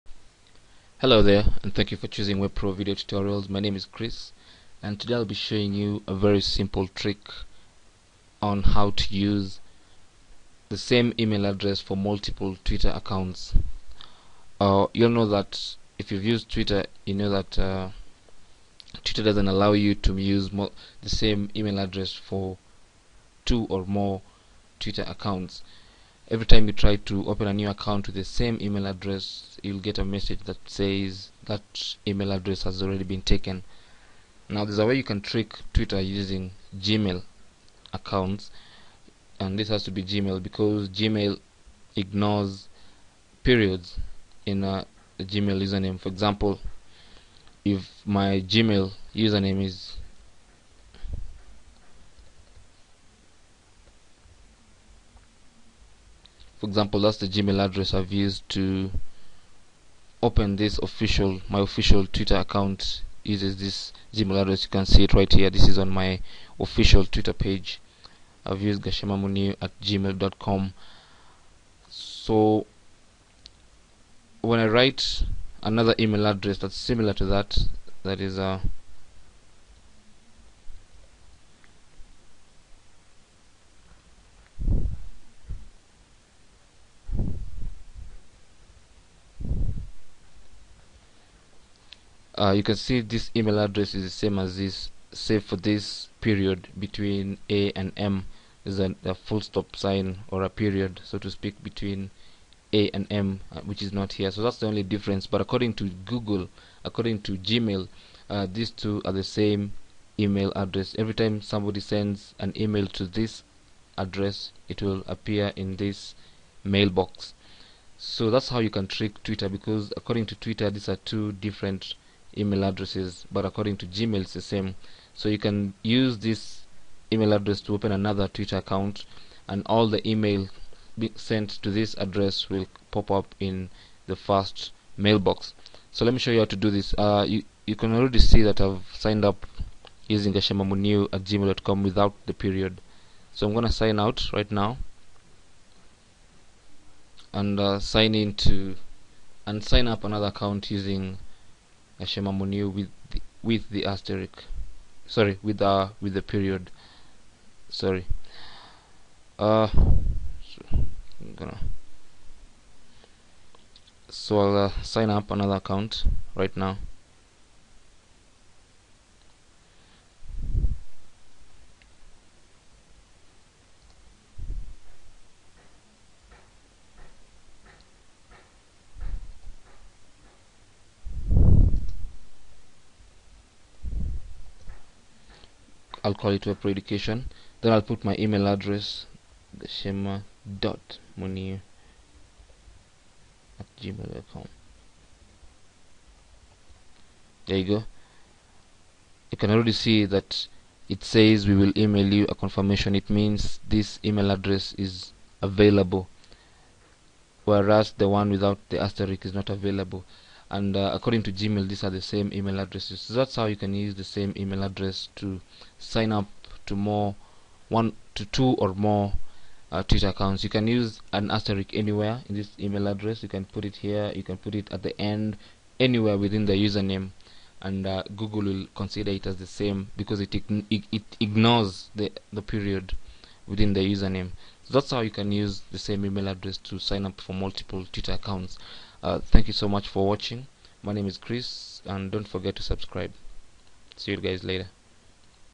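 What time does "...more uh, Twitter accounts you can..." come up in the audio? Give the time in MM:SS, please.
03:38.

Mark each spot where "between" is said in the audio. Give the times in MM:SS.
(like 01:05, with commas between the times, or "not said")
01:36, 01:41.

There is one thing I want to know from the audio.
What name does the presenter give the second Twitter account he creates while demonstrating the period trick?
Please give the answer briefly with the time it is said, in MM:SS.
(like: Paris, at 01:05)
WebPro Education, at 03:06.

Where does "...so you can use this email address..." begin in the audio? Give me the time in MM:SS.
02:05.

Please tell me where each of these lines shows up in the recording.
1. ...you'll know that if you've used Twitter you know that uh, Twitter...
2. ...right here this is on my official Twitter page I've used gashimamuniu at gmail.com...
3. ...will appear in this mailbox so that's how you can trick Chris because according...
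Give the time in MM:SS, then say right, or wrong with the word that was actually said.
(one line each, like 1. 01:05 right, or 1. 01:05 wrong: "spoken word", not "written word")
1. 00:14 right
2. 01:05 right
3. 01:54 wrong: "Twitter", not "Chris".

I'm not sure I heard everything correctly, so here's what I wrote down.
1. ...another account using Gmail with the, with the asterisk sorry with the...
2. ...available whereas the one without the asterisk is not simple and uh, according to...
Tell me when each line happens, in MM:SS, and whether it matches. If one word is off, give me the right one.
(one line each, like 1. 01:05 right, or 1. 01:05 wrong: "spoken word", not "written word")
1. 02:30 wrong: "Ashema", not "Gmail"
2. 03:25 wrong: "available", not "simple".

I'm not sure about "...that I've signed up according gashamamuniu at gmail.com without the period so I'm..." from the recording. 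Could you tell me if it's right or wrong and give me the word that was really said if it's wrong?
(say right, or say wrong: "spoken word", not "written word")
wrong: "using", not "according".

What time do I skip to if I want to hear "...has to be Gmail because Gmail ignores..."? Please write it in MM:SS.
00:39.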